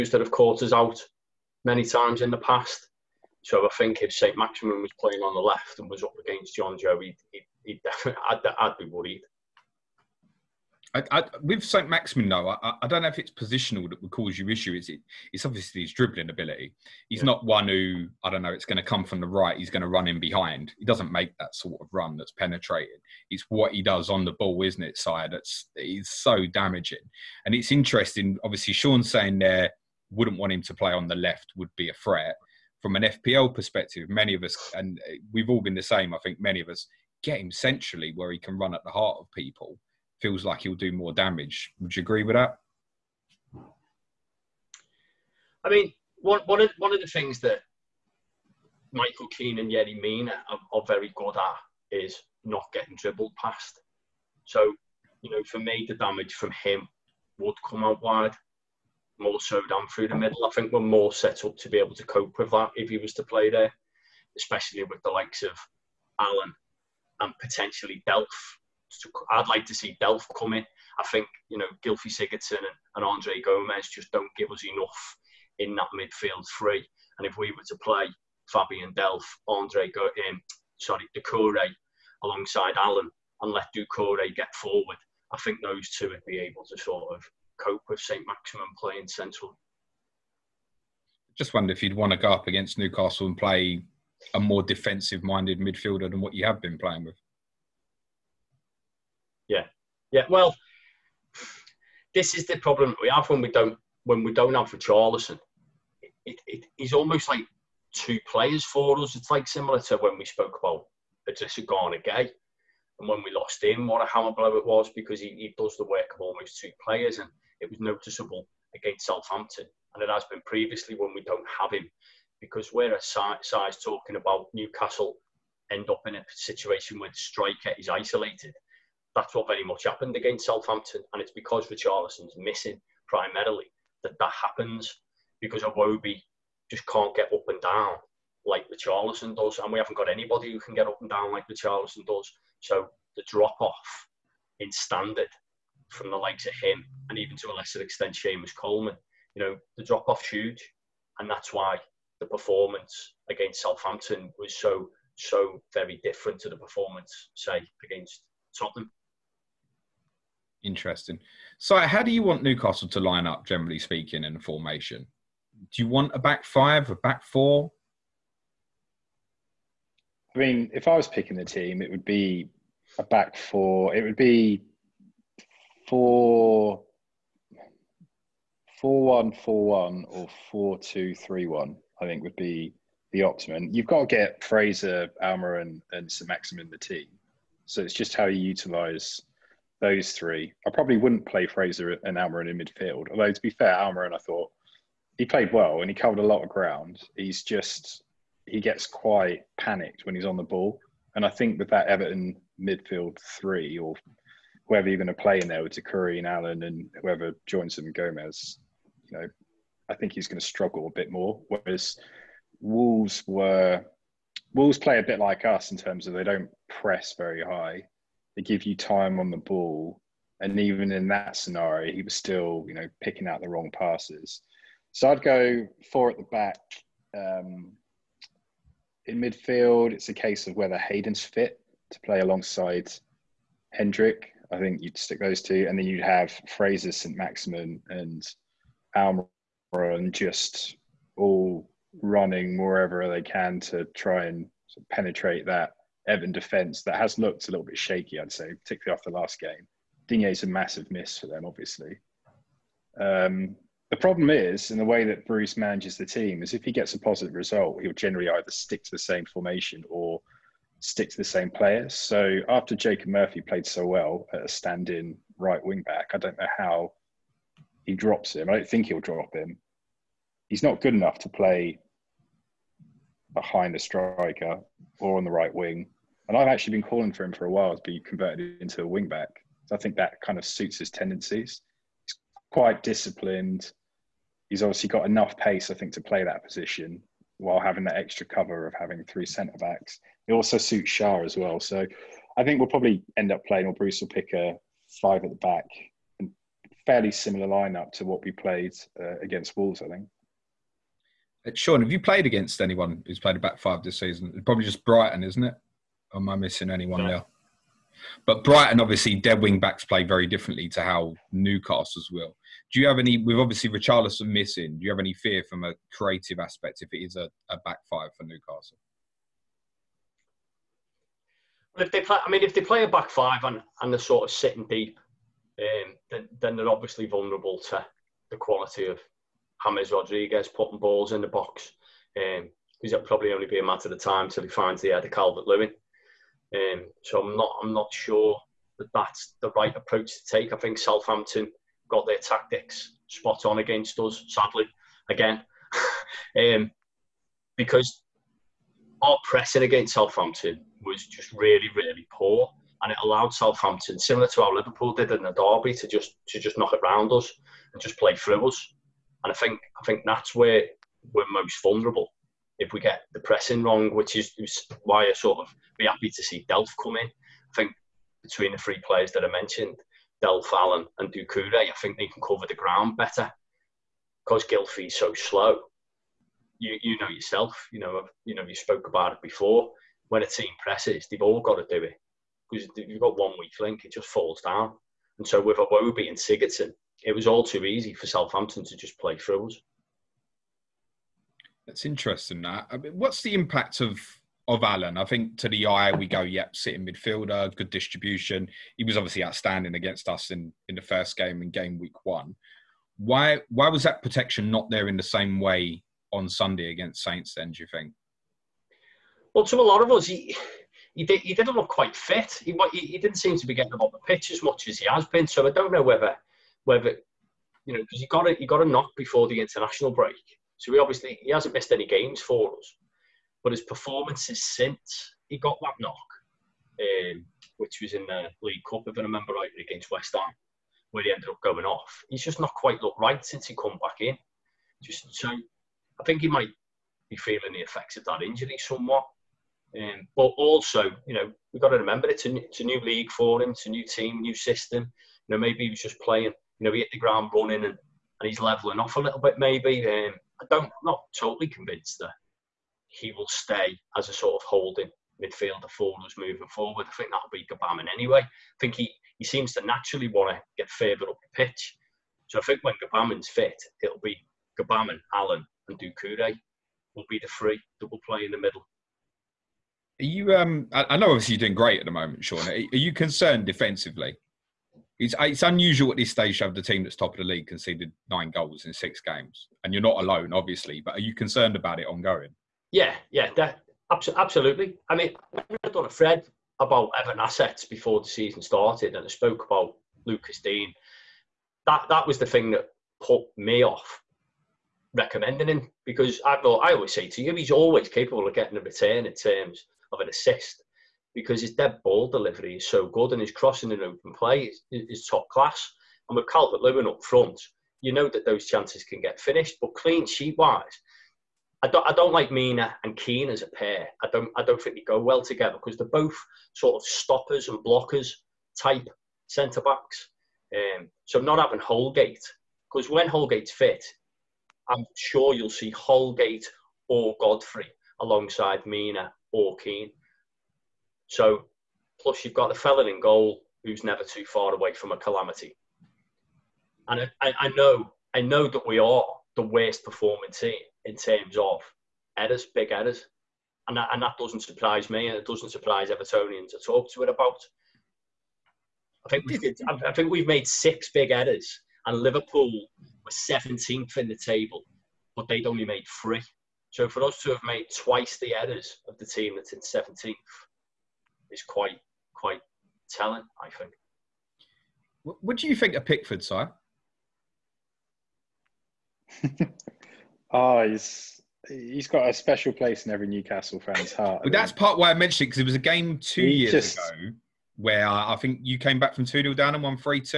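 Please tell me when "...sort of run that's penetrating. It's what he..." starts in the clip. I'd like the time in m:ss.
0:21.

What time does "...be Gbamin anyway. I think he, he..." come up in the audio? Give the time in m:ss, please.
7:37.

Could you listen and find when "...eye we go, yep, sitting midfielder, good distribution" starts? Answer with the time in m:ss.
6:35.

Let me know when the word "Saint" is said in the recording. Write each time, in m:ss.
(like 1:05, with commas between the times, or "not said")
0:11, 6:47.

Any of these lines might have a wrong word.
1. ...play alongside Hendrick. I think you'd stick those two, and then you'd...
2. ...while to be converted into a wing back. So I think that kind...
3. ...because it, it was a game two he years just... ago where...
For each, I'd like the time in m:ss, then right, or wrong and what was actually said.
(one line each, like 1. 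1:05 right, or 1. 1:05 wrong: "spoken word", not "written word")
1. 3:52 right
2. 4:37 right
3. 9:35 right.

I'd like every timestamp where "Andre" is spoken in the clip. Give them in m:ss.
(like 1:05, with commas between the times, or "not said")
1:13, 1:19.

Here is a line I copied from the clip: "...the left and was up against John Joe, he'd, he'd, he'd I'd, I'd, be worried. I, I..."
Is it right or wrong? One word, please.
right.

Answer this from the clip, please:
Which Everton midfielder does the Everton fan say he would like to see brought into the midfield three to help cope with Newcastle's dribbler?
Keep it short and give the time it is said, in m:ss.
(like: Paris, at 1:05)
Fabian Delph, at 1:18.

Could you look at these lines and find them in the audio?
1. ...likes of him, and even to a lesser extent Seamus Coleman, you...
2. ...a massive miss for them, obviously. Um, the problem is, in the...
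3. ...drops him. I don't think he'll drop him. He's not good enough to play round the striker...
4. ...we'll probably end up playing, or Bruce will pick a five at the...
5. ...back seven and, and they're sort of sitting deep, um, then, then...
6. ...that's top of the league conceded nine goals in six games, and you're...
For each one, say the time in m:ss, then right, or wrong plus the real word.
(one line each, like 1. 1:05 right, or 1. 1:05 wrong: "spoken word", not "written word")
1. 2:26 right
2. 4:10 right
3. 4:27 wrong: "behind", not "round"
4. 4:52 right
5. 5:22 wrong: "five", not "seven"
6. 7:56 right.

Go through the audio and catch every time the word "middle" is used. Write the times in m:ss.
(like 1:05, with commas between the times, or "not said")
1:00, 7:48.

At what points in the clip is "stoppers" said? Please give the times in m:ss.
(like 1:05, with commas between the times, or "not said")
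8:36.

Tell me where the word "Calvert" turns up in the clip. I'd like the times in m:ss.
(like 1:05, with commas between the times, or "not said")
5:35, 8:26.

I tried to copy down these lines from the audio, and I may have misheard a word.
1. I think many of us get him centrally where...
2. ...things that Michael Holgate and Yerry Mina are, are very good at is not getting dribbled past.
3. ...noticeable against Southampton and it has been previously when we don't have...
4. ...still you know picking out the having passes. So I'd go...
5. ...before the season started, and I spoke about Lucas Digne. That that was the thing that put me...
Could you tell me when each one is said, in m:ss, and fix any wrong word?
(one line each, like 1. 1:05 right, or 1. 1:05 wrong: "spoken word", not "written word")
1. 0:36 right
2. 0:47 wrong: "Keane", not "Holgate"
3. 1:57 right
4. 3:42 wrong: "wrong", not "having"
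5. 8:07 right.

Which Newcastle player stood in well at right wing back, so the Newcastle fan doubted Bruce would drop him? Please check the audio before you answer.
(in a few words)
Jacob Murphy.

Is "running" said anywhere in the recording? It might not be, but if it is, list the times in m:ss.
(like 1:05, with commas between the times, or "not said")
4:02, 7:27.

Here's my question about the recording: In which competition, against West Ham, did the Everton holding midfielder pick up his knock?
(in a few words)
League Cup.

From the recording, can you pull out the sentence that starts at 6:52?
He, he, he didn't seem to be getting on the pitch as much as he has been.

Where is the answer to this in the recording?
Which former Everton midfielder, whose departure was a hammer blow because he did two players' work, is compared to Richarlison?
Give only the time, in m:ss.
1:51.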